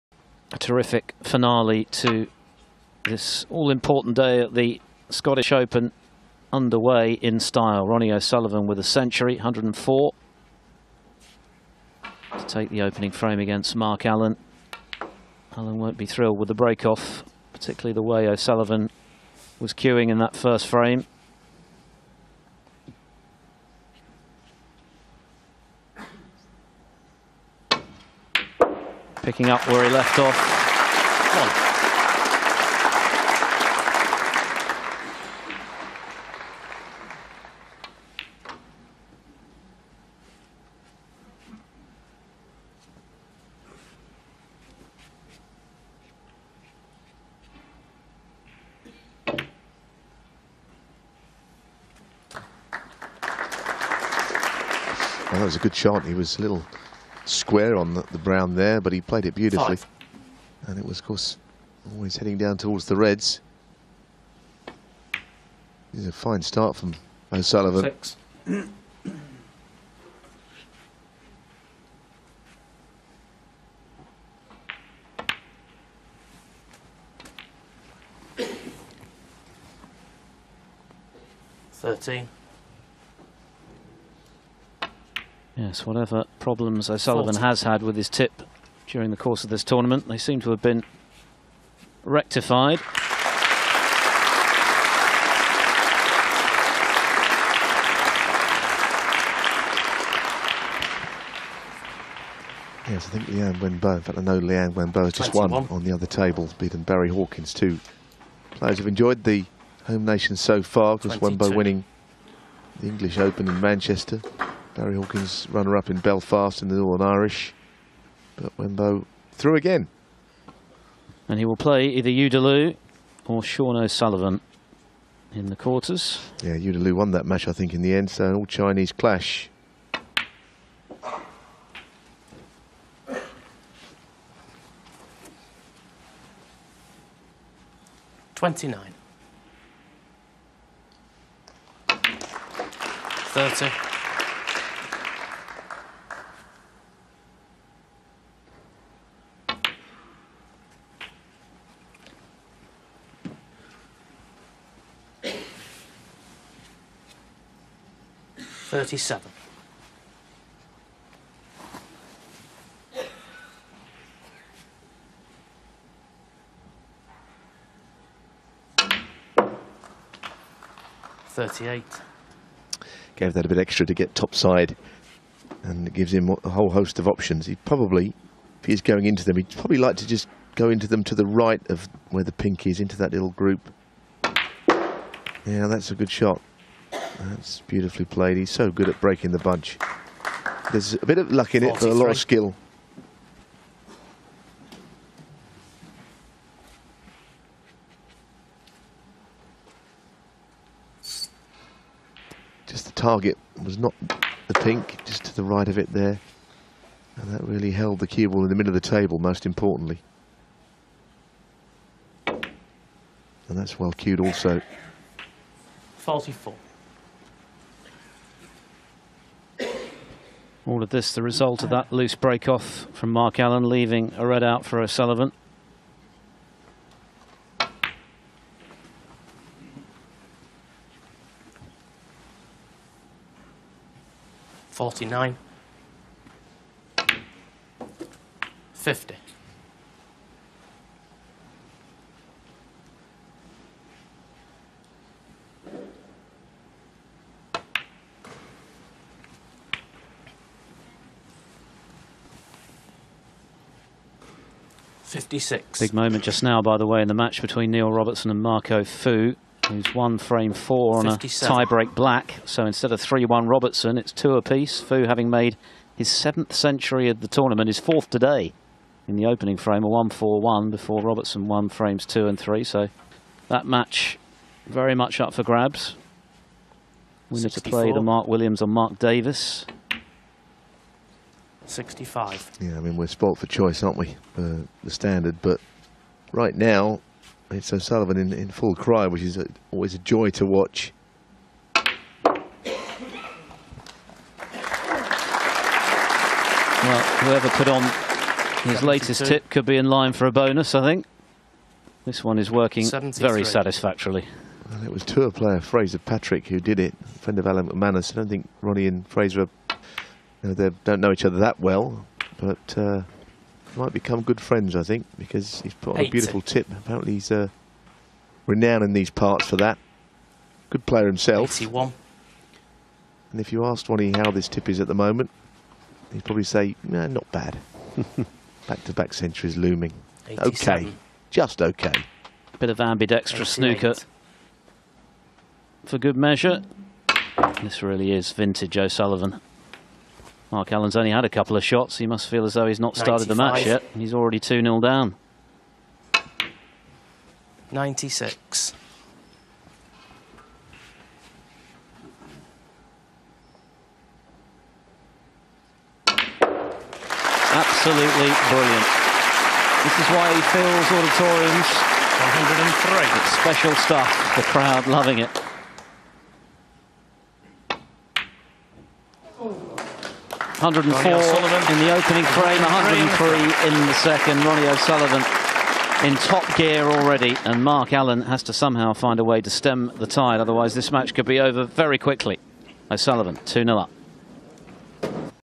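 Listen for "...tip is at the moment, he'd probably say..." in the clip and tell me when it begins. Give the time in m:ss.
5:24.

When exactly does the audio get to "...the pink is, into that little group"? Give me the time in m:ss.
3:02.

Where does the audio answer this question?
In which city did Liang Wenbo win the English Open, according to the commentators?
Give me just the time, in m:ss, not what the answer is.
1:53.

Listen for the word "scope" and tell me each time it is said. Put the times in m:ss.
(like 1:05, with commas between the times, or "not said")
not said.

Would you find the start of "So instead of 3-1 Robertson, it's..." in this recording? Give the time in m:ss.
4:22.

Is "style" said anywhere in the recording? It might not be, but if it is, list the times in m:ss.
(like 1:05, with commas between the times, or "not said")
0:07.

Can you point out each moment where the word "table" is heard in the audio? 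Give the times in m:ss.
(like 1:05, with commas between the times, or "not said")
1:46, 3:28.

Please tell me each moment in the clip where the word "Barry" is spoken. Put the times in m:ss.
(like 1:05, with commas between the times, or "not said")
1:46, 1:54.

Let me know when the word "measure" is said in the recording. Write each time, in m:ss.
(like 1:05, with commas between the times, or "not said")
5:36.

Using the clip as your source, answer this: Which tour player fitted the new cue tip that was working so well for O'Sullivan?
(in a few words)
Fraser Patrick.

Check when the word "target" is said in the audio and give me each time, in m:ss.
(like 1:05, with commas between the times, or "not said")
3:22.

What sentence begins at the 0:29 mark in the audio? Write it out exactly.
picking up where he left off.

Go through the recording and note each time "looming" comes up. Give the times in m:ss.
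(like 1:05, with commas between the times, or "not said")
5:29.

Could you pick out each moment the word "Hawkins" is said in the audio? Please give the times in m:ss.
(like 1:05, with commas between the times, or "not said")
1:47, 1:54.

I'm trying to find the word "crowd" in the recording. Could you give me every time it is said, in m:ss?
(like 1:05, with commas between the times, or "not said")
6:04.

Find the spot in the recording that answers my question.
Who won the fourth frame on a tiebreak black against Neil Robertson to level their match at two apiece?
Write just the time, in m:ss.
4:18.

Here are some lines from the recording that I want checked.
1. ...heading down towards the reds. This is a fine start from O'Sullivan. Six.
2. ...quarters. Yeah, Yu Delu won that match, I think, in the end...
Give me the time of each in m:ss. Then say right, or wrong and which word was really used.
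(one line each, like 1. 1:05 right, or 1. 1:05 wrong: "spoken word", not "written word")
1. 1:02 right
2. 2:05 right.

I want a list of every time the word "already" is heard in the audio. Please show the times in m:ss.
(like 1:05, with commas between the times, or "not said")
5:44, 6:16.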